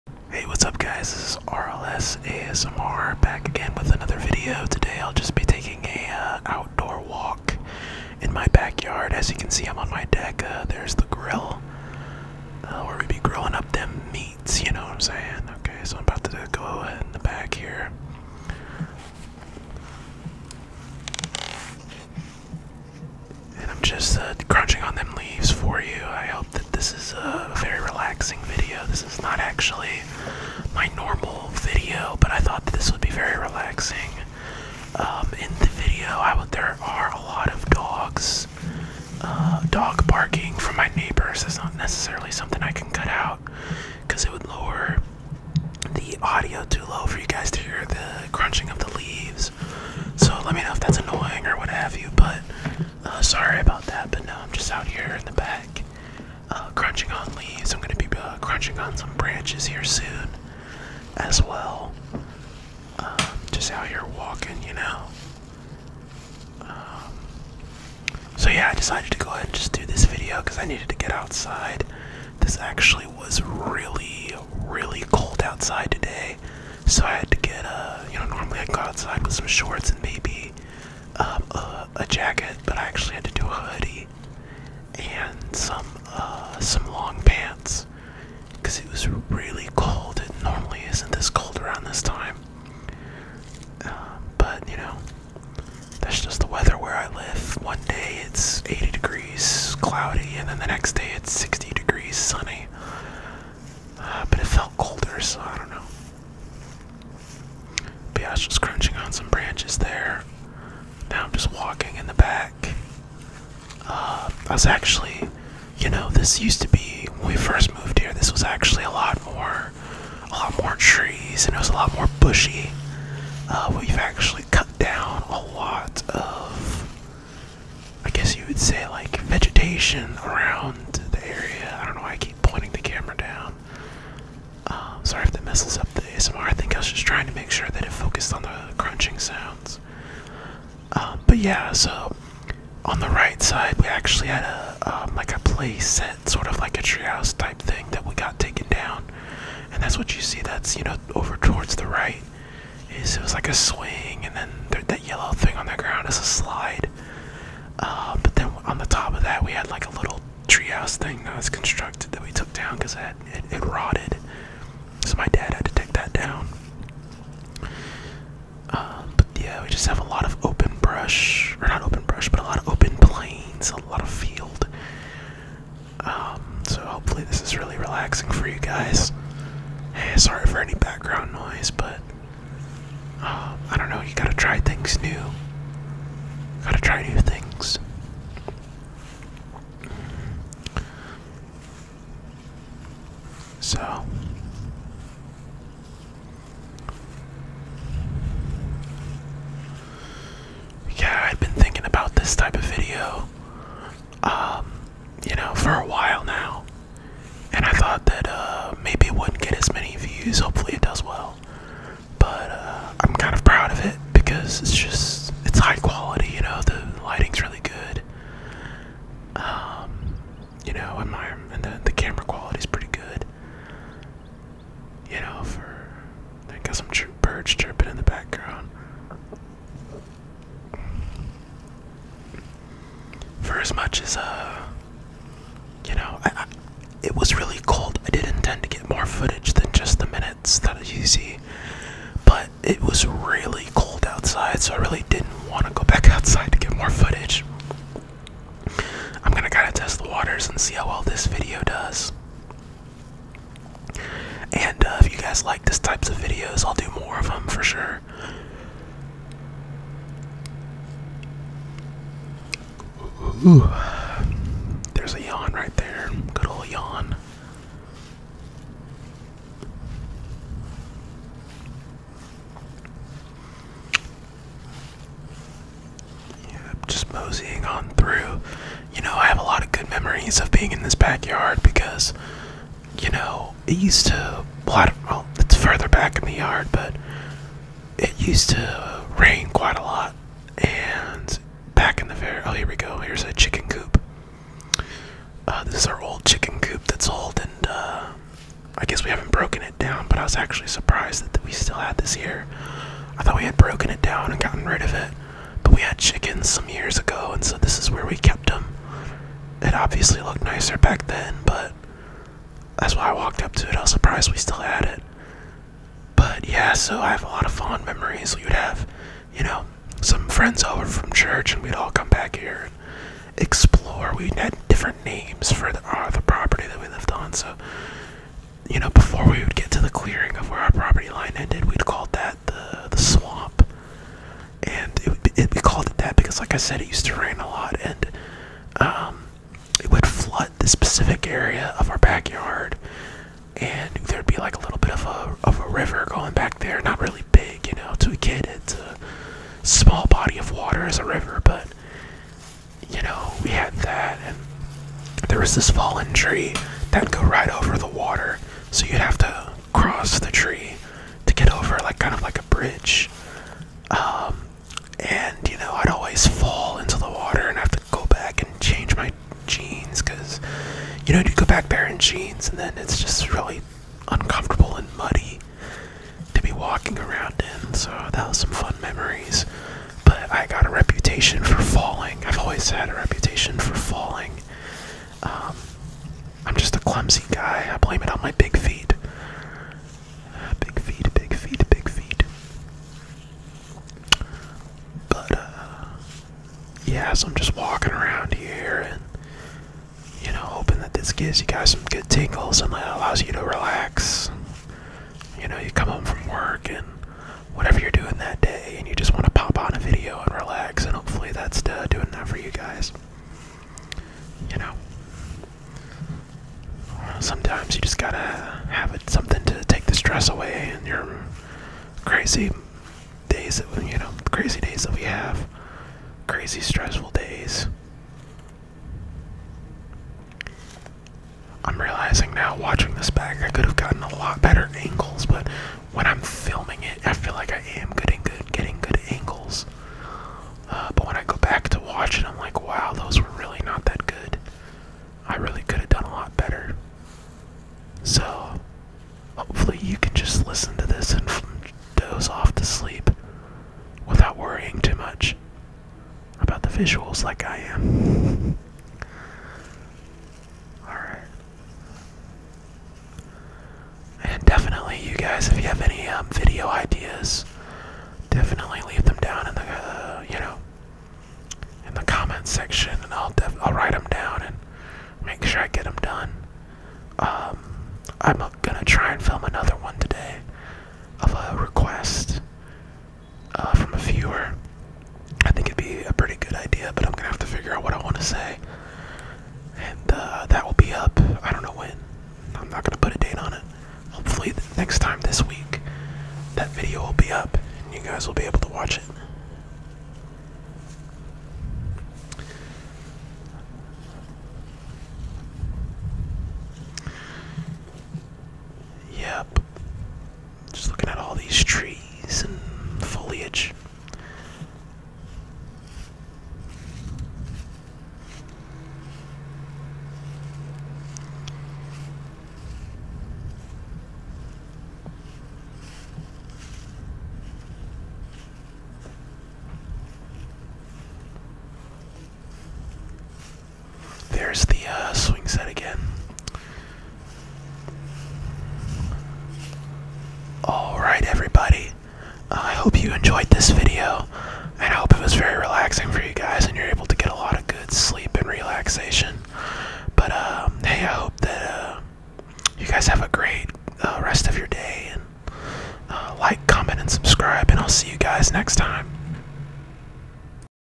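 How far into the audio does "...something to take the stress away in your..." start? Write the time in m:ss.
6:59.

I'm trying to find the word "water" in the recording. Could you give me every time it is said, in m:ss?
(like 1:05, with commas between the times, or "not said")
4:10, 5:50, 5:57, 6:07.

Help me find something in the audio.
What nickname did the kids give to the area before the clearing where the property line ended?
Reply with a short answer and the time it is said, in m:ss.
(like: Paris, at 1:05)
the swamp, at 5:32.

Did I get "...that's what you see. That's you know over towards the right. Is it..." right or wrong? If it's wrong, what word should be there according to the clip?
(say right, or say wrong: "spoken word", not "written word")
right.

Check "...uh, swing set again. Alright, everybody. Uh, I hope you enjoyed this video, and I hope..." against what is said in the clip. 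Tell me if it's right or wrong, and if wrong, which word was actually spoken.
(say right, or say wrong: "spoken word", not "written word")
right.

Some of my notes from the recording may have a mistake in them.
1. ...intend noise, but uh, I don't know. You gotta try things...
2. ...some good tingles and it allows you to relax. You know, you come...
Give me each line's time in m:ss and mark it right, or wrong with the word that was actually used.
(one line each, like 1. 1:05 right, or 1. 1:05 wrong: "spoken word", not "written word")
1. 3:00 wrong: "background", not "intend"
2. 6:41 right.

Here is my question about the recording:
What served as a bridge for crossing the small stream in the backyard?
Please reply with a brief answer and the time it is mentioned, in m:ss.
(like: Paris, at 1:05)
fallen tree, at 5:55.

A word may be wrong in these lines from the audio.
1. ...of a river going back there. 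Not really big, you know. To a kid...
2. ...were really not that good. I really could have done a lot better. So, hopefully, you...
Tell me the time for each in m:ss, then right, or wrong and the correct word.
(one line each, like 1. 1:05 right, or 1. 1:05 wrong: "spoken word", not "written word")
1. 5:45 right
2. 7:23 right.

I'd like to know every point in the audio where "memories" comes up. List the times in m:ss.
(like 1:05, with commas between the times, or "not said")
5:17, 6:18.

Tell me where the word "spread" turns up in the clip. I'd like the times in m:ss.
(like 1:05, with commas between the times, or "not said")
not said.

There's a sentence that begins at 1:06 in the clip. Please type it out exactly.
Um, so, yeah, I decided to go ahead and just do this video because I needed to get outside.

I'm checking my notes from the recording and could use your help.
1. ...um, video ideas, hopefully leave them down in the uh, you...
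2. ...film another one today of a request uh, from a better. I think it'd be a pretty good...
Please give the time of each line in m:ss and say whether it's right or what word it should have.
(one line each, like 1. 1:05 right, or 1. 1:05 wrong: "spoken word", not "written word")
1. 7:46 wrong: "definitely", not "hopefully"
2. 7:59 wrong: "viewer", not "better".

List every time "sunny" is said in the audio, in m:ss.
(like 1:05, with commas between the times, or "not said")
1:42.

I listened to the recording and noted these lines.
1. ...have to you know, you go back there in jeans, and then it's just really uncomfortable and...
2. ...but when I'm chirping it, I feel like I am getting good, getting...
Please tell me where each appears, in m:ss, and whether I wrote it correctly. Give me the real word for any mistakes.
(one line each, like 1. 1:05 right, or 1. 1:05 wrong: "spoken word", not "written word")
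1. 6:07 right
2. 7:15 wrong: "filming", not "chirping".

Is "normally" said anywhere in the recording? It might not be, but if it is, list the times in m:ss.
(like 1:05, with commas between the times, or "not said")
1:18, 1:30.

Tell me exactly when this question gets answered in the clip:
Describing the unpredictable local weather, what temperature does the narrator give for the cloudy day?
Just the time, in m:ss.
1:38.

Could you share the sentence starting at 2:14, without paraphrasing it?
Um, sorry if that messes up the ASMR.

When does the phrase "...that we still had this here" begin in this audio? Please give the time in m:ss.
5:01.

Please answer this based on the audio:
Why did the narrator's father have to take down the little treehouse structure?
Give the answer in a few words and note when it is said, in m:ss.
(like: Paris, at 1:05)
it rotted, at 2:43.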